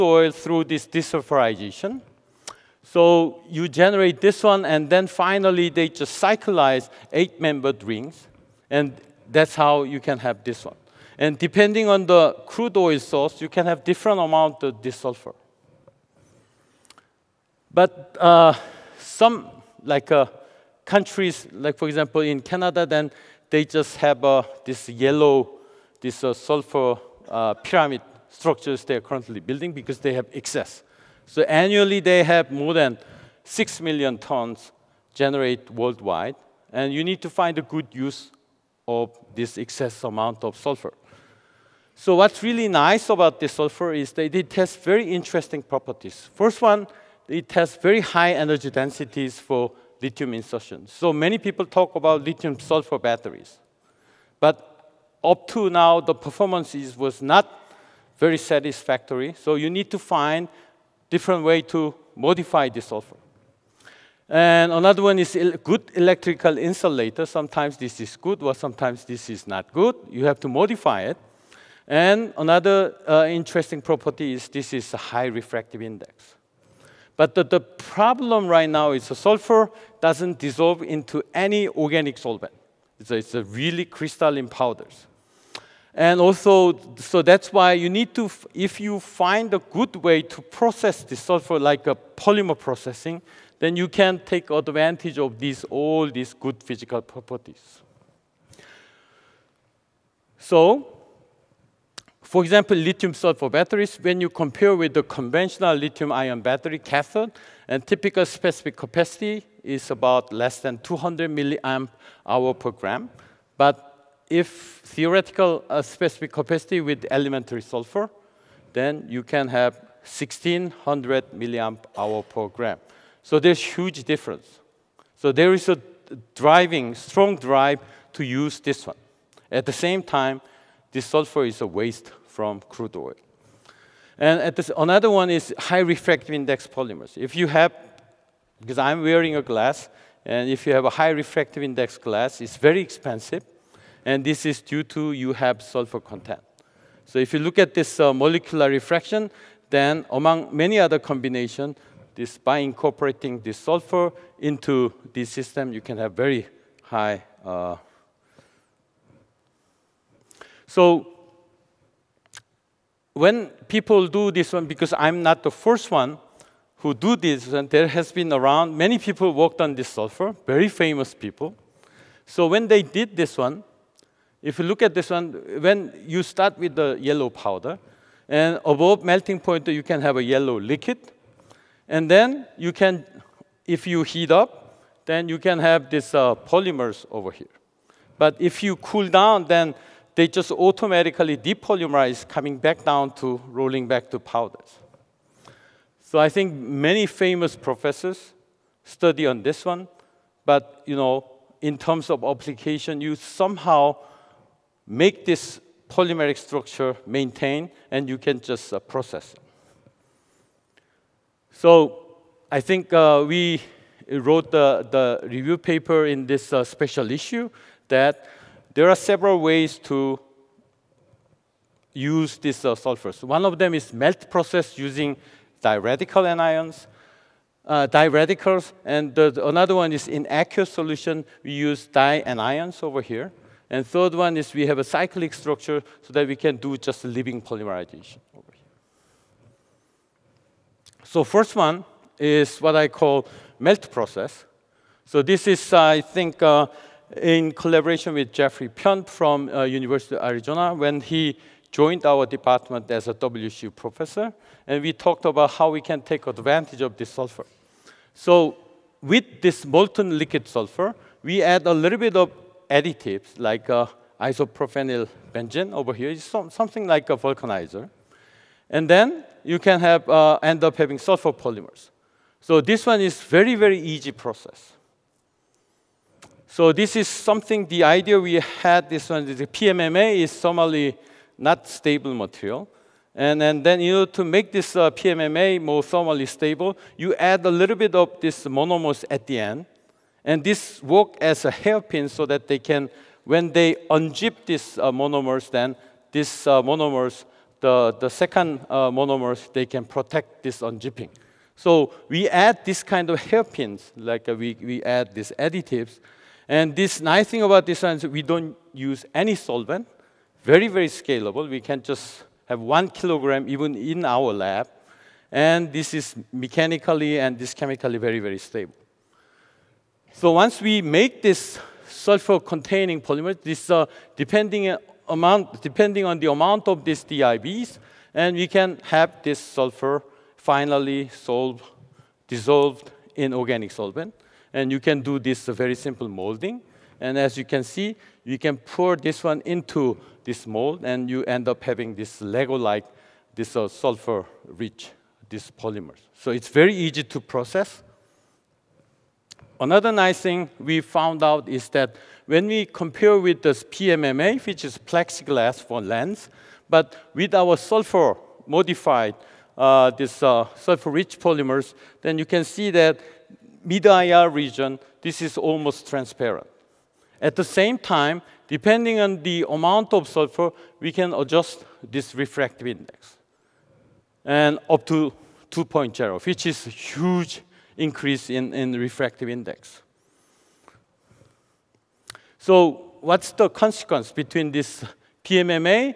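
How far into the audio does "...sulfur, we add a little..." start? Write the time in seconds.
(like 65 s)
260 s.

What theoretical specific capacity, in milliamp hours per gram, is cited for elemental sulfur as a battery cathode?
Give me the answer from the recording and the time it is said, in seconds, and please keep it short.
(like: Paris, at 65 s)
1600, at 120 s.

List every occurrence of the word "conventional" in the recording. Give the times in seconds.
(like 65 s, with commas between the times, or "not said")
105 s.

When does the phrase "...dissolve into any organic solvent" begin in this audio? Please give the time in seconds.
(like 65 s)
80 s.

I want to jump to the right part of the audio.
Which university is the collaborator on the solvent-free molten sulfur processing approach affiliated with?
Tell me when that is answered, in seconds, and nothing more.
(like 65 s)
249 s.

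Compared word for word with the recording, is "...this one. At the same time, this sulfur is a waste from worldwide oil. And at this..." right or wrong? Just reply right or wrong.
wrong.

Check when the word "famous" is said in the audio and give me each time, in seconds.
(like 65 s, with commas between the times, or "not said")
170 s, 197 s.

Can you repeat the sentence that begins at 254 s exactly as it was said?
And we talked about how we can take advantage of this sulfur.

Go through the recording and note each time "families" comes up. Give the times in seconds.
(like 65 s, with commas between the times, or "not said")
not said.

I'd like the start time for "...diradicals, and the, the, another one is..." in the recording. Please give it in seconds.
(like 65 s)
227 s.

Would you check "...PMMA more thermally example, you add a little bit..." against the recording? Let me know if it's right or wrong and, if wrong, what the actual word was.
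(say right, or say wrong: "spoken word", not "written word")
wrong: "stable", not "example".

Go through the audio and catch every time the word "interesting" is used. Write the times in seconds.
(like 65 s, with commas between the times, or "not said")
45 s, 73 s.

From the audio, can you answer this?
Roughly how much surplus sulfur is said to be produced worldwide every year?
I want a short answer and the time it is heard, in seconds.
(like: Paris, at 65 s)
more than 6 million tons, at 32 s.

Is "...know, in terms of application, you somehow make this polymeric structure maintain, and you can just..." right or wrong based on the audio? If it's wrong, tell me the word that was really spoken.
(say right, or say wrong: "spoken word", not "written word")
right.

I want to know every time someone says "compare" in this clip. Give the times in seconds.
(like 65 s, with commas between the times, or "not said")
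104 s, 352 s.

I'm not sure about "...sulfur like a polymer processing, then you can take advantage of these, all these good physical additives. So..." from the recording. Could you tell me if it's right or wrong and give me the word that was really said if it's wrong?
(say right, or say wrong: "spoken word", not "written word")
wrong: "properties", not "additives".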